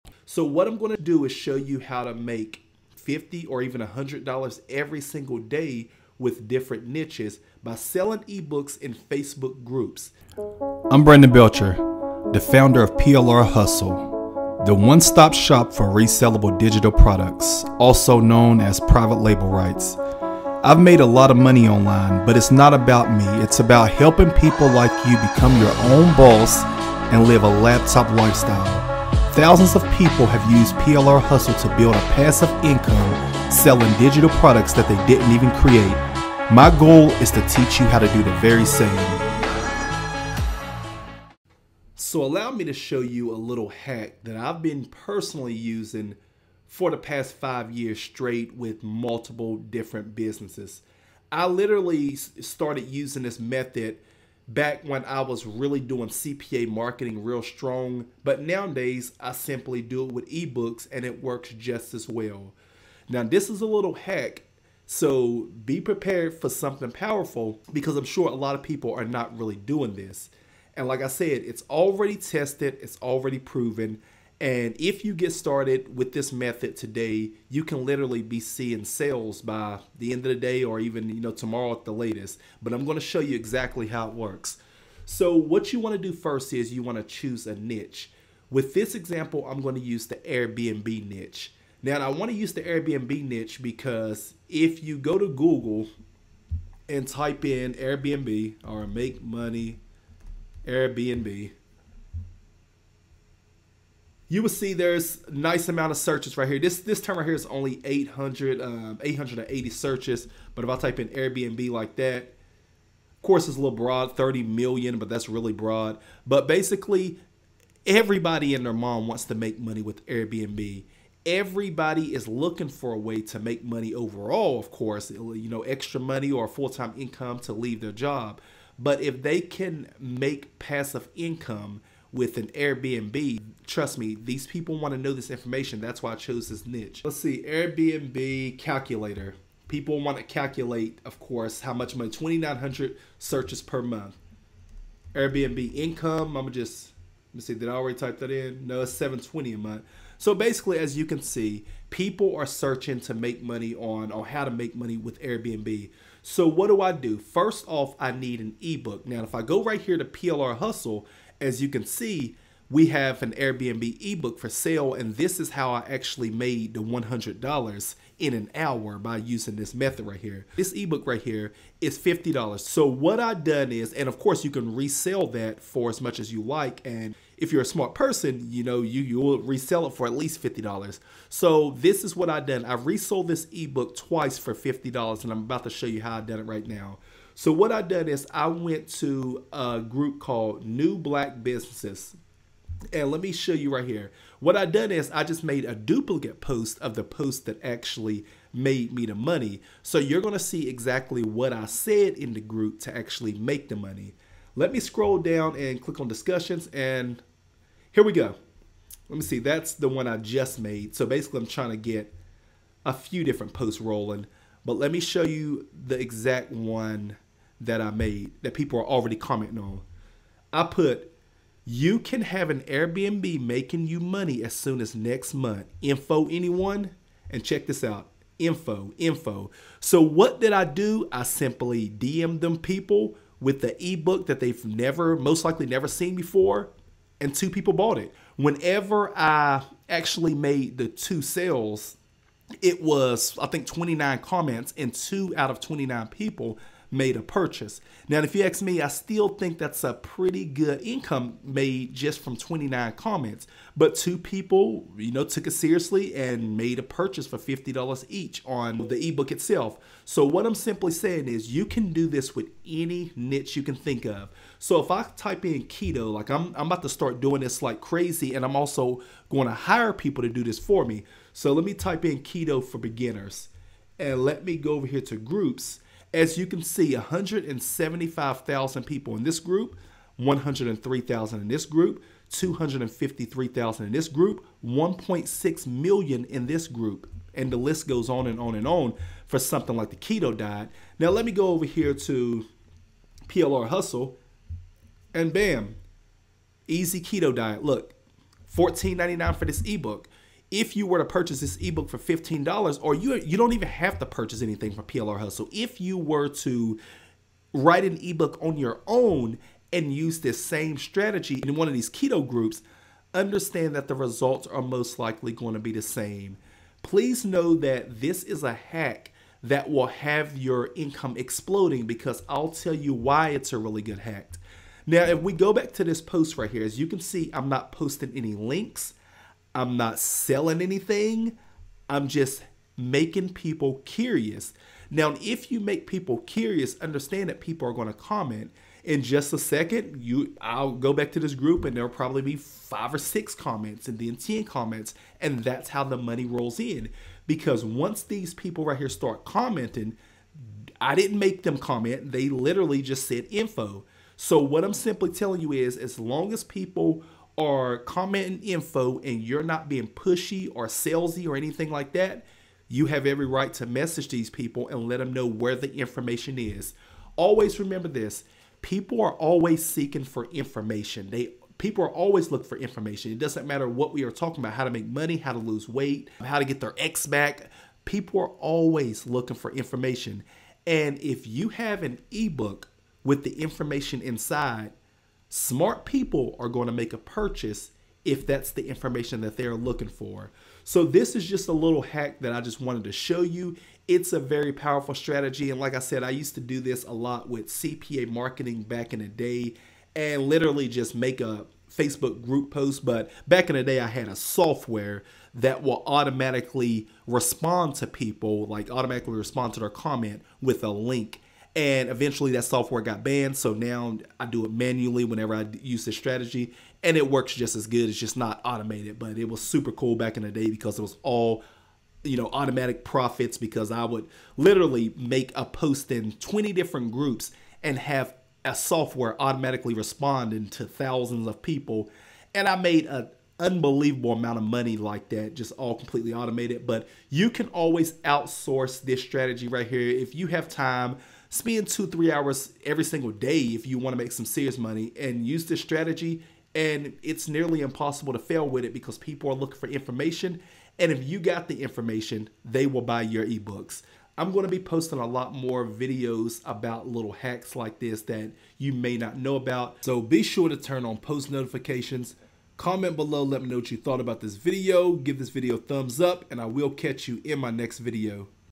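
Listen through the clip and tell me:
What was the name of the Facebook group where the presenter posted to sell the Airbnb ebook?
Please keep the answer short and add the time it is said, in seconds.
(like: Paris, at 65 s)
New Black Businesses, at 190 s.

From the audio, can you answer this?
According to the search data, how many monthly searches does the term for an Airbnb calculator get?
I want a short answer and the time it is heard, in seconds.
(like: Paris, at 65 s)
2,900, at 142 s.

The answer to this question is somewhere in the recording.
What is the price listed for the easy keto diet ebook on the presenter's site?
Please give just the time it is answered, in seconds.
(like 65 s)
298 s.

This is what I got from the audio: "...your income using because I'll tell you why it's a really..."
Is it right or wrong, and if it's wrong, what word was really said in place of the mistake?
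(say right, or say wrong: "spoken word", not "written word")
wrong: "exploding", not "using".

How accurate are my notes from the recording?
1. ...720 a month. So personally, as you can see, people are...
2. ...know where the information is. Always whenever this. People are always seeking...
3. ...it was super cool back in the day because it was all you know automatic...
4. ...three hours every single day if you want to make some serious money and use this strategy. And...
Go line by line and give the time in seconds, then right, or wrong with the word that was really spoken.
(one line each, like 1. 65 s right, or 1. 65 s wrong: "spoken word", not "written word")
1. 148 s wrong: "basically", not "personally"
2. 365 s wrong: "remember", not "whenever"
3. 419 s right
4. 441 s right.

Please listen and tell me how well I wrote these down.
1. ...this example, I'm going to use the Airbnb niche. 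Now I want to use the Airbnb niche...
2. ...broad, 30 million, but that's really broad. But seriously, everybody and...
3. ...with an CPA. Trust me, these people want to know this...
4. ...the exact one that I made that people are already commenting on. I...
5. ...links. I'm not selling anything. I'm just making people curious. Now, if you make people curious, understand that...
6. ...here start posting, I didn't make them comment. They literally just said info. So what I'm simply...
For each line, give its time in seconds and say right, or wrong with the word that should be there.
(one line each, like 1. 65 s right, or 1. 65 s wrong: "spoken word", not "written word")
1. 88 s right
2. 113 s wrong: "basically", not "seriously"
3. 132 s wrong: "Airbnb", not "CPA"
4. 215 s right
5. 328 s right
6. 348 s wrong: "commenting", not "posting".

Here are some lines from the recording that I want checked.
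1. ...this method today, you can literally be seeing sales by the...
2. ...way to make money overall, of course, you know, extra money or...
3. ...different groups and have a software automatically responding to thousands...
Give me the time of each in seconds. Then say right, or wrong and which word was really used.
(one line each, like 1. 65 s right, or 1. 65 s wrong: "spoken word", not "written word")
1. 76 s right
2. 122 s right
3. 426 s right.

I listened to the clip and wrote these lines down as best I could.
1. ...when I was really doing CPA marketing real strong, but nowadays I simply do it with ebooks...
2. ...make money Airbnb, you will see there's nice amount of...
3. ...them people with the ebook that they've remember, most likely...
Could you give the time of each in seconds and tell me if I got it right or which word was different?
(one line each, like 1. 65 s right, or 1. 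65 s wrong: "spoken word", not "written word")
1. 54 s right
2. 98 s right
3. 232 s wrong: "never", not "remember".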